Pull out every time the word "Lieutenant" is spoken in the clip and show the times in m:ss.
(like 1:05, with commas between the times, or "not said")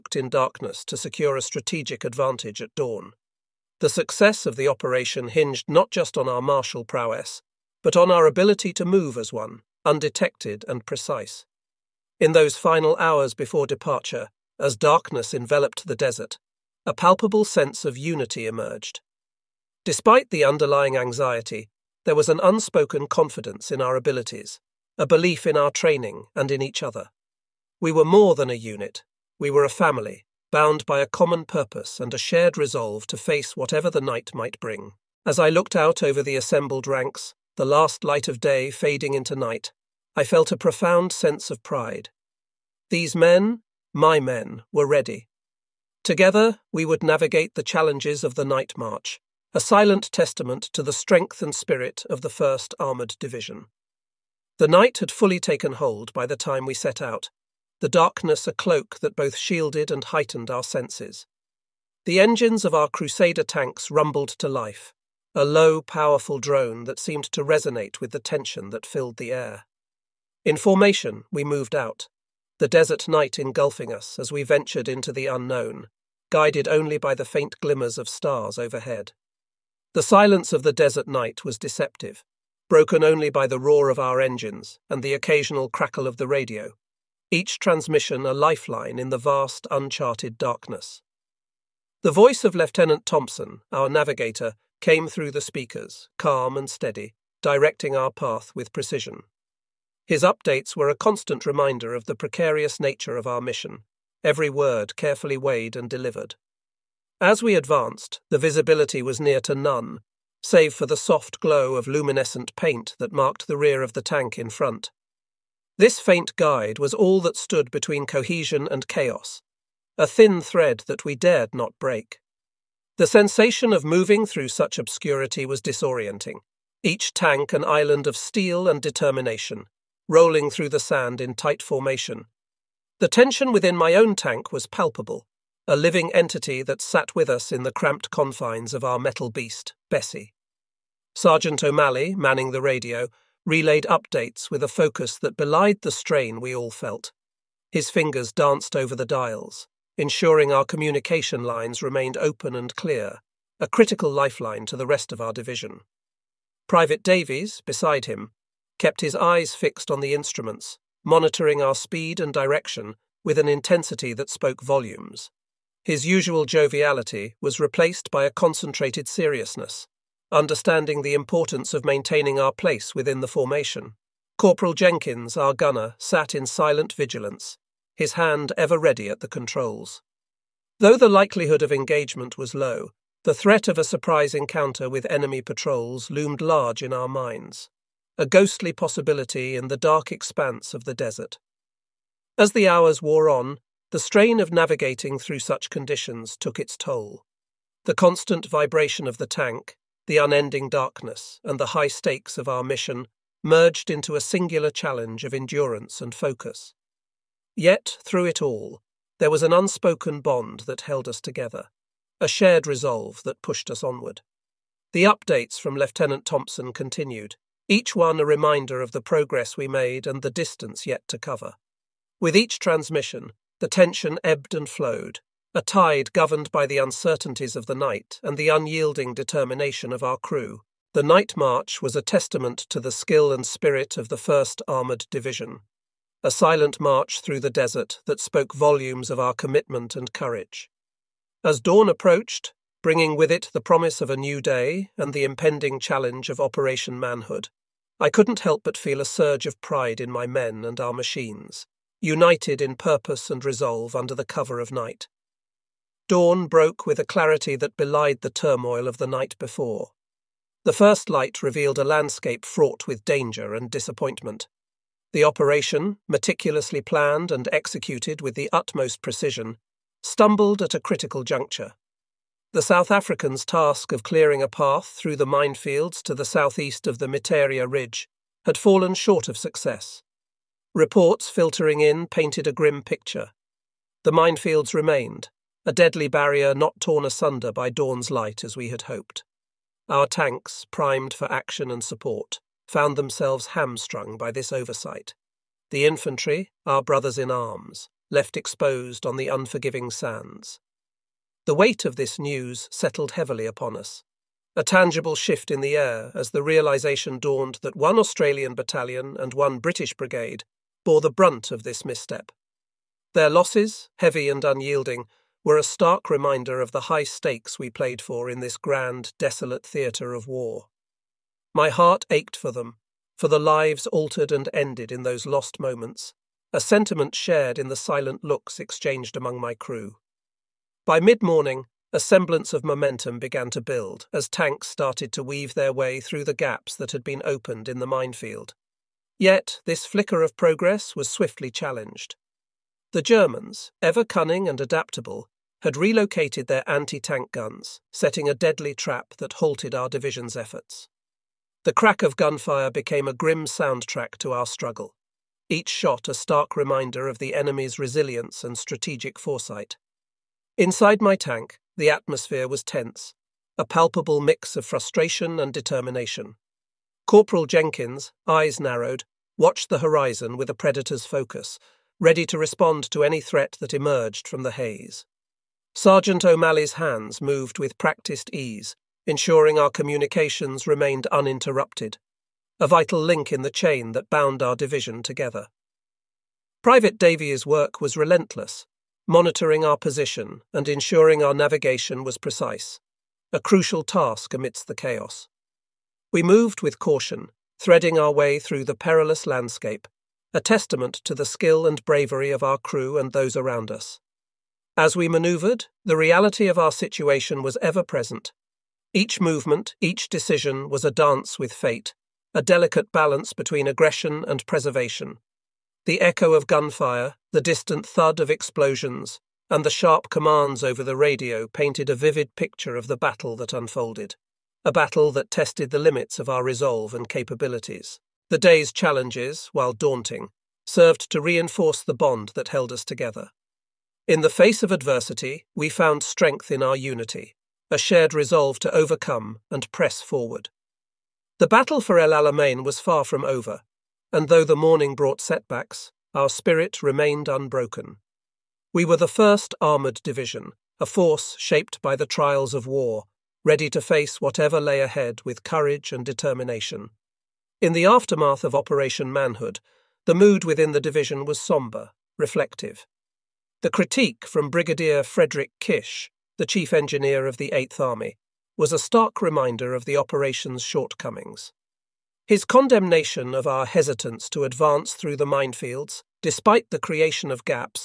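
1:32, 3:35.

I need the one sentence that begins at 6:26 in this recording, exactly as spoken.
Private Davies' work was relentless, monitoring our position and ensuring our navigation was precise, a crucial task amidst the chaos.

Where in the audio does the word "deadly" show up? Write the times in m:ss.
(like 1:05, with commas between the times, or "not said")
4:45, 5:48.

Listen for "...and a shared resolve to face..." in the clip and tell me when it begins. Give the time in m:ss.
0:31.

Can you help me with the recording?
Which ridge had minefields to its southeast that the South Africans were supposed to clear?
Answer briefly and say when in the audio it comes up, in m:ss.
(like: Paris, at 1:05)
Miteirya Ridge, at 4:37.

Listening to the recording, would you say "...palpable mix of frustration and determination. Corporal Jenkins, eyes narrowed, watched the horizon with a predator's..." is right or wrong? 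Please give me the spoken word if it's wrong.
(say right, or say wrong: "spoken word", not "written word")
right.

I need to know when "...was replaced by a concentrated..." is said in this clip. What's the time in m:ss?
2:47.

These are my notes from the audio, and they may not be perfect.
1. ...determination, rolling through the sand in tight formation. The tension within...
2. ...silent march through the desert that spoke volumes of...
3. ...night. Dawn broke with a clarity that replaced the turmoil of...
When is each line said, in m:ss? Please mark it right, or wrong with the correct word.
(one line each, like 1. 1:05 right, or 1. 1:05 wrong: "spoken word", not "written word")
1. 2:08 right
2. 3:56 right
3. 4:14 wrong: "belied", not "replaced".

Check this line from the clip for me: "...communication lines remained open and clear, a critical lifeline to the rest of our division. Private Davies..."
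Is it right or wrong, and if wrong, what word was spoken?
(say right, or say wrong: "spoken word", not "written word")
right.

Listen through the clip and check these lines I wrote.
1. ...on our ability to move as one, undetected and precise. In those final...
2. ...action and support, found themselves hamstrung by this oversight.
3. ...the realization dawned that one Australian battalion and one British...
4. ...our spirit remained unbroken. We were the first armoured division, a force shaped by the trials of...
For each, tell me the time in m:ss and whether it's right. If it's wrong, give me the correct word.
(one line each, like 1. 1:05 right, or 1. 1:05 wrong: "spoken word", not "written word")
1. 0:07 right
2. 4:51 right
3. 5:06 right
4. 7:26 right.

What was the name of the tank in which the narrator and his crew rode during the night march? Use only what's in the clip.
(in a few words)
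Bessie.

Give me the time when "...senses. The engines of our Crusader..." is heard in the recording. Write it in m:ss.
1:00.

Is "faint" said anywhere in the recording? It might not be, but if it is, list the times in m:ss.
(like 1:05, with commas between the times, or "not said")
1:17, 1:56.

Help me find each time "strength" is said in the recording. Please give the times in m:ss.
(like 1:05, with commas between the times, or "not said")
0:50, 7:16.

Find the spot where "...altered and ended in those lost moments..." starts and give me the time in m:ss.
5:23.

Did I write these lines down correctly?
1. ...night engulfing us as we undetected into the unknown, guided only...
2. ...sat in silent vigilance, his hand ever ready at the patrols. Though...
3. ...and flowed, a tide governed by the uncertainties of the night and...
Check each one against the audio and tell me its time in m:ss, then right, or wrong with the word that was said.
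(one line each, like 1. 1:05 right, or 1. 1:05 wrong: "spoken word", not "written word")
1. 1:13 wrong: "ventured", not "undetected"
2. 2:55 wrong: "controls", not "patrols"
3. 3:44 right.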